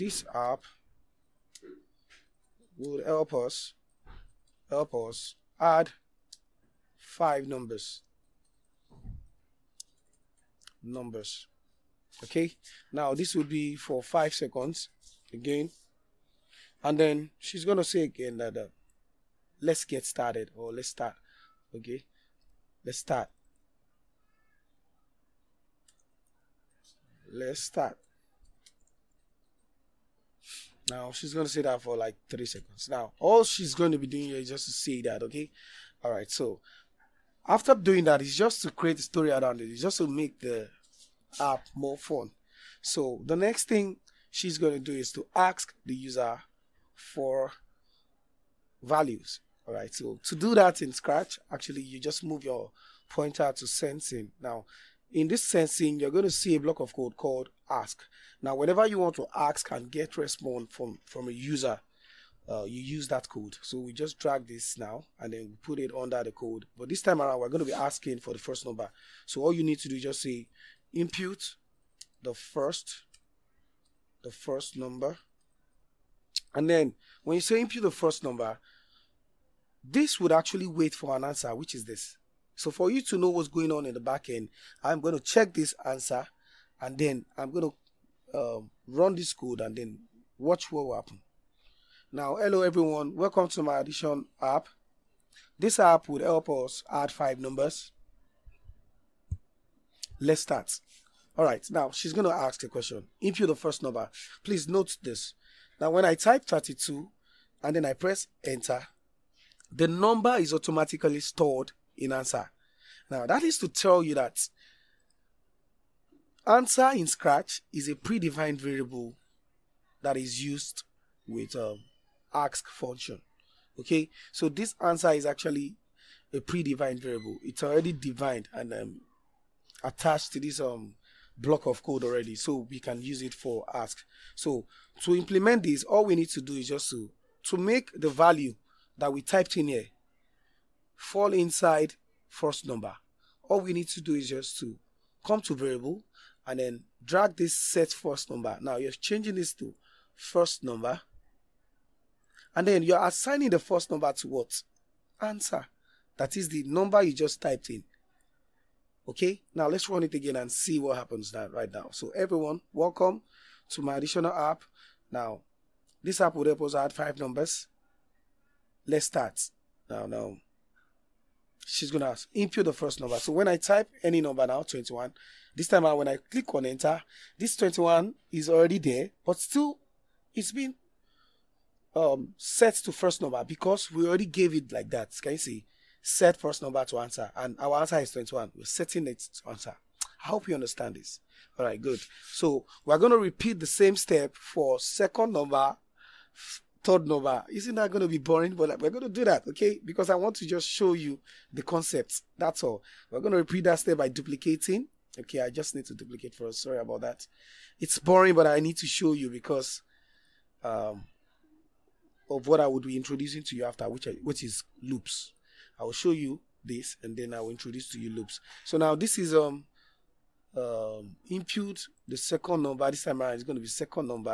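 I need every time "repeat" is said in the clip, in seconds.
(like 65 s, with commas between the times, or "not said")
193 s, 203 s.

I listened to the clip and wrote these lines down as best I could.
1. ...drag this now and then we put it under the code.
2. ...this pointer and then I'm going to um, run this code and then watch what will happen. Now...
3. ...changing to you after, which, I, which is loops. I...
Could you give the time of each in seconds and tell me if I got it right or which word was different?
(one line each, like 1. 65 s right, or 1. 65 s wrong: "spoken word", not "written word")
1. 64 s right
2. 85 s wrong: "answer", not "pointer"
3. 212 s wrong: "introducing", not "changing".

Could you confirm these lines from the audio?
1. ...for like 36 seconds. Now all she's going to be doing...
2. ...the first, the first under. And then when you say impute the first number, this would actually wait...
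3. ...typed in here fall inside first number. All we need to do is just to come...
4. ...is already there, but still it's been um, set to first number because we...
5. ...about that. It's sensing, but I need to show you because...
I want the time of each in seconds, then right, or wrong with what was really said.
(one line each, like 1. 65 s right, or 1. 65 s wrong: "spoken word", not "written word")
1. 31 s wrong: "30", not "36"
2. 72 s wrong: "number", not "under"
3. 139 s right
4. 178 s right
5. 206 s wrong: "boring", not "sensing".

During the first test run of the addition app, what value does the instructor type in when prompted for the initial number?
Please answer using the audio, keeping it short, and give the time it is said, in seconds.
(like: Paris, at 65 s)
32, at 106 s.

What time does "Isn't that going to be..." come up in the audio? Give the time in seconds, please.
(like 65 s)
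197 s.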